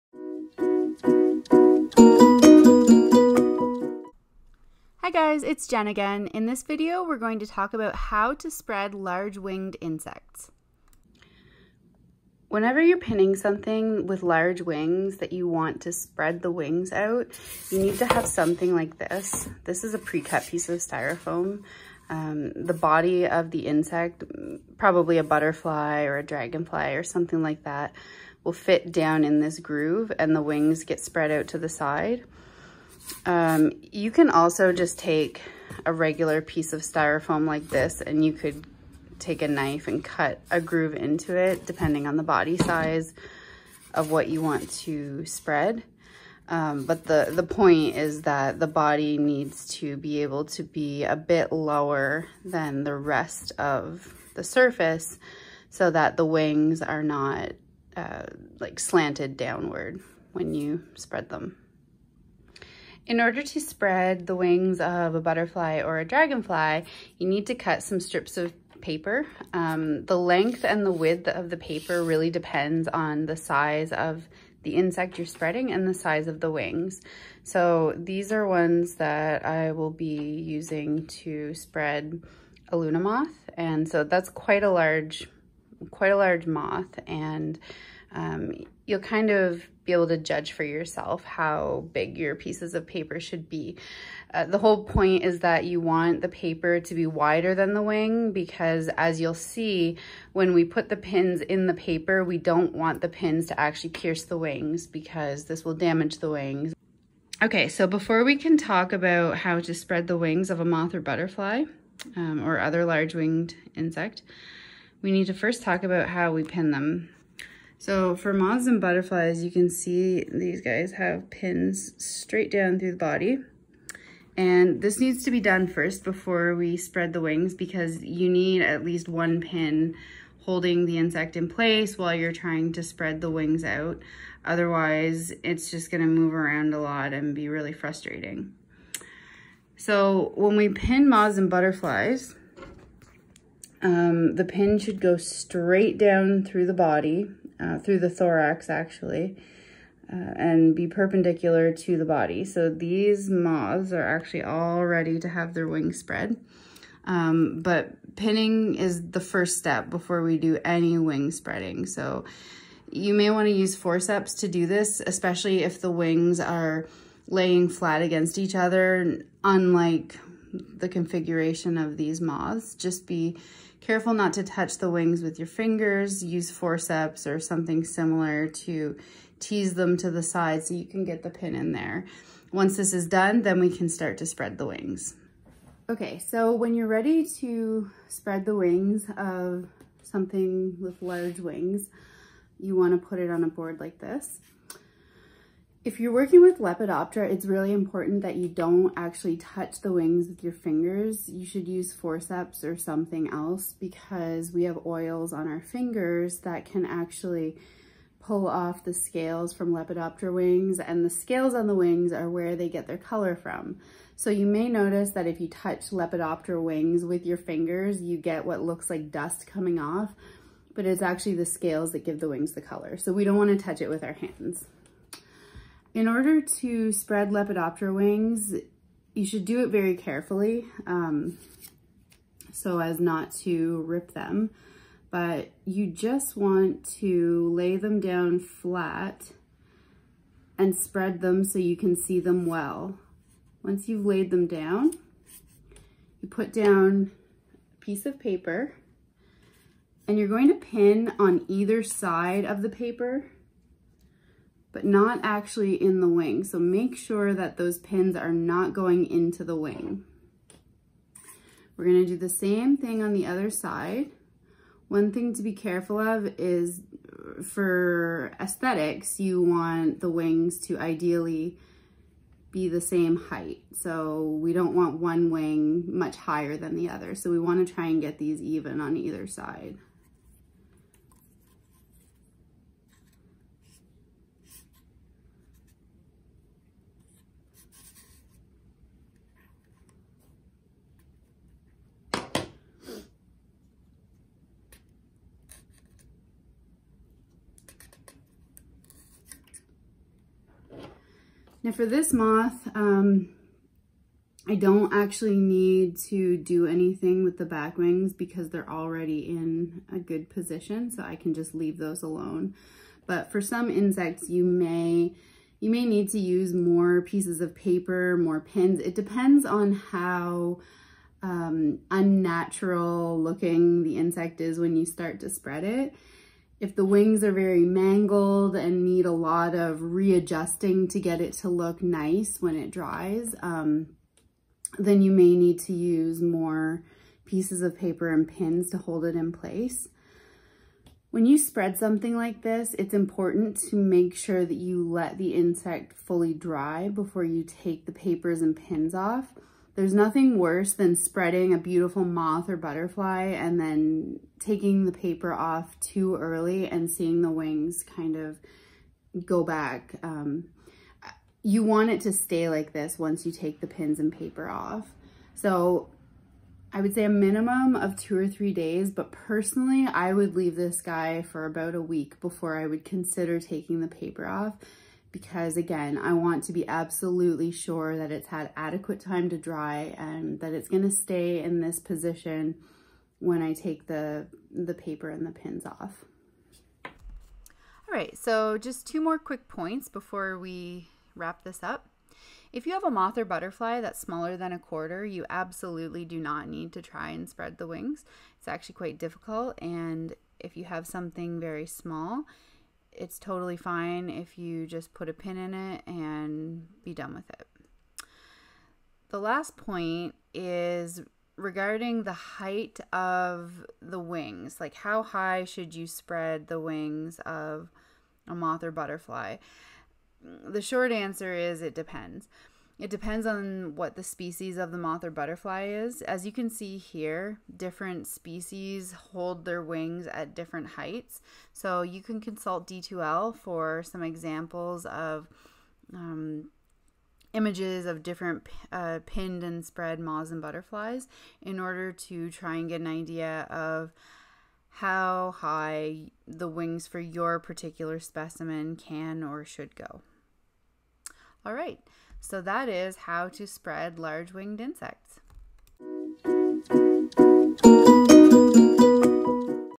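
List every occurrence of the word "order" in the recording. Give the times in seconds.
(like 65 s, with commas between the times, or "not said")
63 s, 226 s, 441 s.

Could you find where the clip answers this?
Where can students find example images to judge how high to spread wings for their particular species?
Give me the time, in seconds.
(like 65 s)
432 s.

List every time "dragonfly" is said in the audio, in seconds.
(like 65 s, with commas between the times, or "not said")
26 s, 66 s.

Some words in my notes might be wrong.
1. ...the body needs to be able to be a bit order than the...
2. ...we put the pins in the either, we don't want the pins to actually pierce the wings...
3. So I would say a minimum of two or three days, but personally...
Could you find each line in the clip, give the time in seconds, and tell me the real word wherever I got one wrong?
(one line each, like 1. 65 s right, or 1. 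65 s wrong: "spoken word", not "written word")
1. 48 s wrong: "lower", not "order"
2. 100 s wrong: "paper", not "either"
3. 365 s right.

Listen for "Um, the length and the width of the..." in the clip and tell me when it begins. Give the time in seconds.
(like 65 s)
69 s.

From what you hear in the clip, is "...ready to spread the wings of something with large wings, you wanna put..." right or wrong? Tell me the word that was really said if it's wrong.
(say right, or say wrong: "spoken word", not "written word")
right.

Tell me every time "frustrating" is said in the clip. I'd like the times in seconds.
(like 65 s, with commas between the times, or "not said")
137 s.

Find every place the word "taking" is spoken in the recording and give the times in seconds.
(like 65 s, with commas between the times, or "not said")
354 s, 373 s.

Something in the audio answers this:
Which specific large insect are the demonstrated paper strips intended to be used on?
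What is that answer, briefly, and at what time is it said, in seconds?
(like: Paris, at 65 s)
Luna moth, at 82 s.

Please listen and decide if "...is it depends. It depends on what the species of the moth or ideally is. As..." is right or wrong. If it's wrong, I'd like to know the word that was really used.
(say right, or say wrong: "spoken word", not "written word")
wrong: "butterfly", not "ideally".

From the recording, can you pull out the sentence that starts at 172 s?
Just be careful not to touch the wings with your fingers.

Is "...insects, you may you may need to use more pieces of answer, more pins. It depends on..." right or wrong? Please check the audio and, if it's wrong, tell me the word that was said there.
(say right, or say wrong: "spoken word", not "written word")
wrong: "paper", not "answer".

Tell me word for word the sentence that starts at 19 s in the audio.
This is a pre-cut piece of styrofoam.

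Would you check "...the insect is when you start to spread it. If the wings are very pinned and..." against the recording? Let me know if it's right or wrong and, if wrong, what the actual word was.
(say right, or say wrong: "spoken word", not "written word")
wrong: "mangled", not "pinned".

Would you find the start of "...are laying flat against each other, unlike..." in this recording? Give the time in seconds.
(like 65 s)
166 s.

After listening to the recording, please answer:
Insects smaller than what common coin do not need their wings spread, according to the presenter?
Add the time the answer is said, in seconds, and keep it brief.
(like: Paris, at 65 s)
A quarter, at 394 s.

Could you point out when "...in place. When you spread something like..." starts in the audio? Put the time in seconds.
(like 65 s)
339 s.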